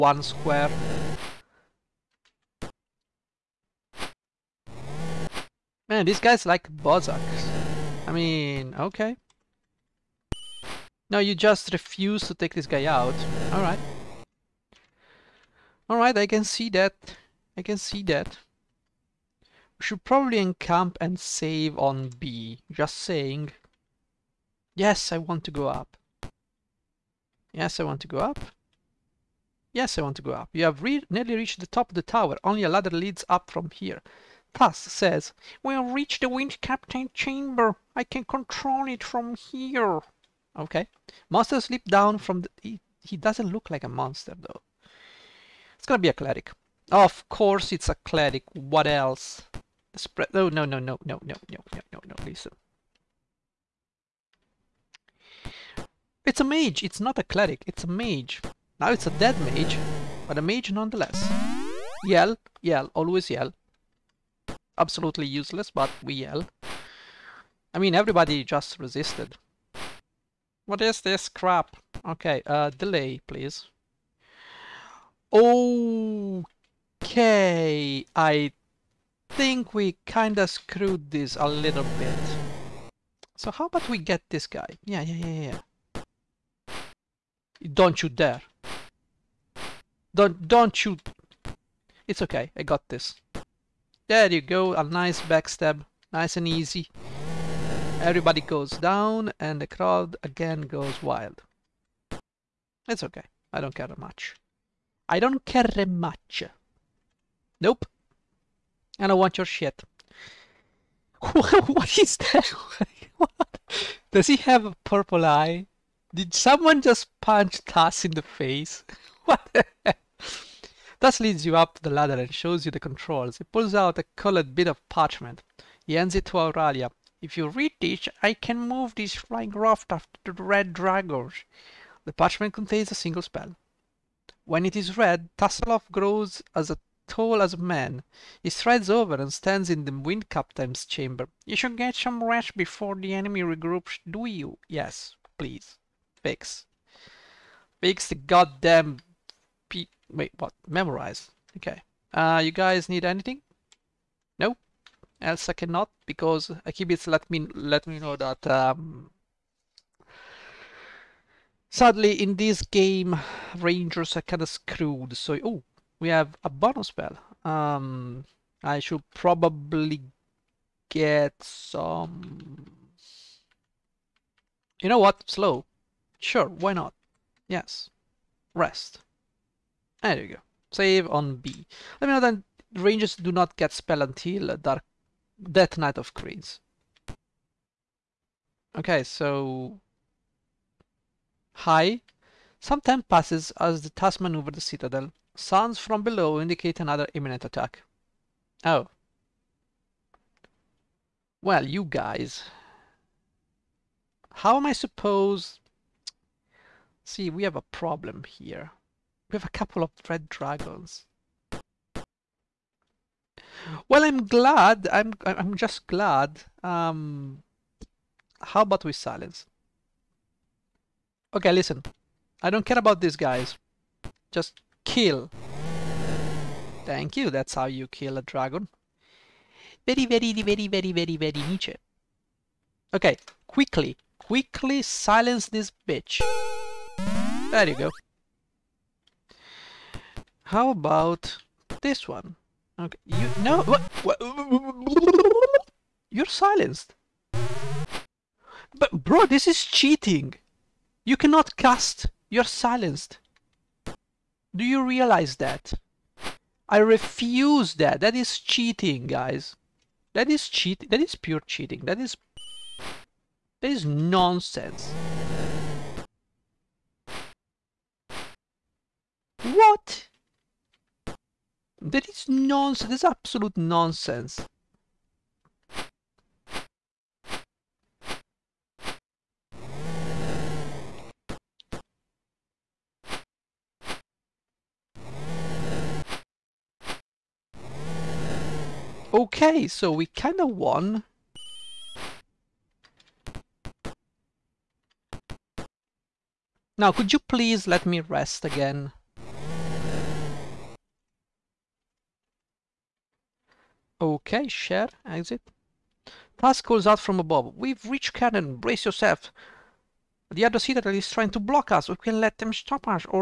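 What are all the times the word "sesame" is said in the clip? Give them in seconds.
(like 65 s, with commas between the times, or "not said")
not said.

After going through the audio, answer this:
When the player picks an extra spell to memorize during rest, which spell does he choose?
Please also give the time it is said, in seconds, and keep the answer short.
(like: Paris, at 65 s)
Slow, at 175 s.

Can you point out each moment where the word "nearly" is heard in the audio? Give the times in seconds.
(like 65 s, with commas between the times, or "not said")
31 s.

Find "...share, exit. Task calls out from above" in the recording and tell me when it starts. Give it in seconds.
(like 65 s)
304 s.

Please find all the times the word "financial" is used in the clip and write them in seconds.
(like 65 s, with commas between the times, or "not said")
not said.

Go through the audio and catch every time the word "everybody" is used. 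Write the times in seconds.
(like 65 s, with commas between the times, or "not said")
67 s, 97 s.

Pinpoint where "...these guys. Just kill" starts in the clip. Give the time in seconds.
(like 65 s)
223 s.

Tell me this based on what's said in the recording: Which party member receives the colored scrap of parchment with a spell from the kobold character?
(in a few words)
Aurelia.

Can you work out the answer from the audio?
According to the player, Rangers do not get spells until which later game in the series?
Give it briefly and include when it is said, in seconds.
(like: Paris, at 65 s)
Dark Death Knight of Krynn, at 184 s.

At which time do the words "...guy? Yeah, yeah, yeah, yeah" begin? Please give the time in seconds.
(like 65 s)
84 s.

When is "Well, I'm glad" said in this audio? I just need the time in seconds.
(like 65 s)
213 s.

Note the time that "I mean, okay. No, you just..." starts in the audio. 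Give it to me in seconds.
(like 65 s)
8 s.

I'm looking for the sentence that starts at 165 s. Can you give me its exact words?
So, oh, we have a bonus spell.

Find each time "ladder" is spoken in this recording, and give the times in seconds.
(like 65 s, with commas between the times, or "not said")
32 s, 121 s.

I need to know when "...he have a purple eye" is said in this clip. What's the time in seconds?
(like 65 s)
114 s.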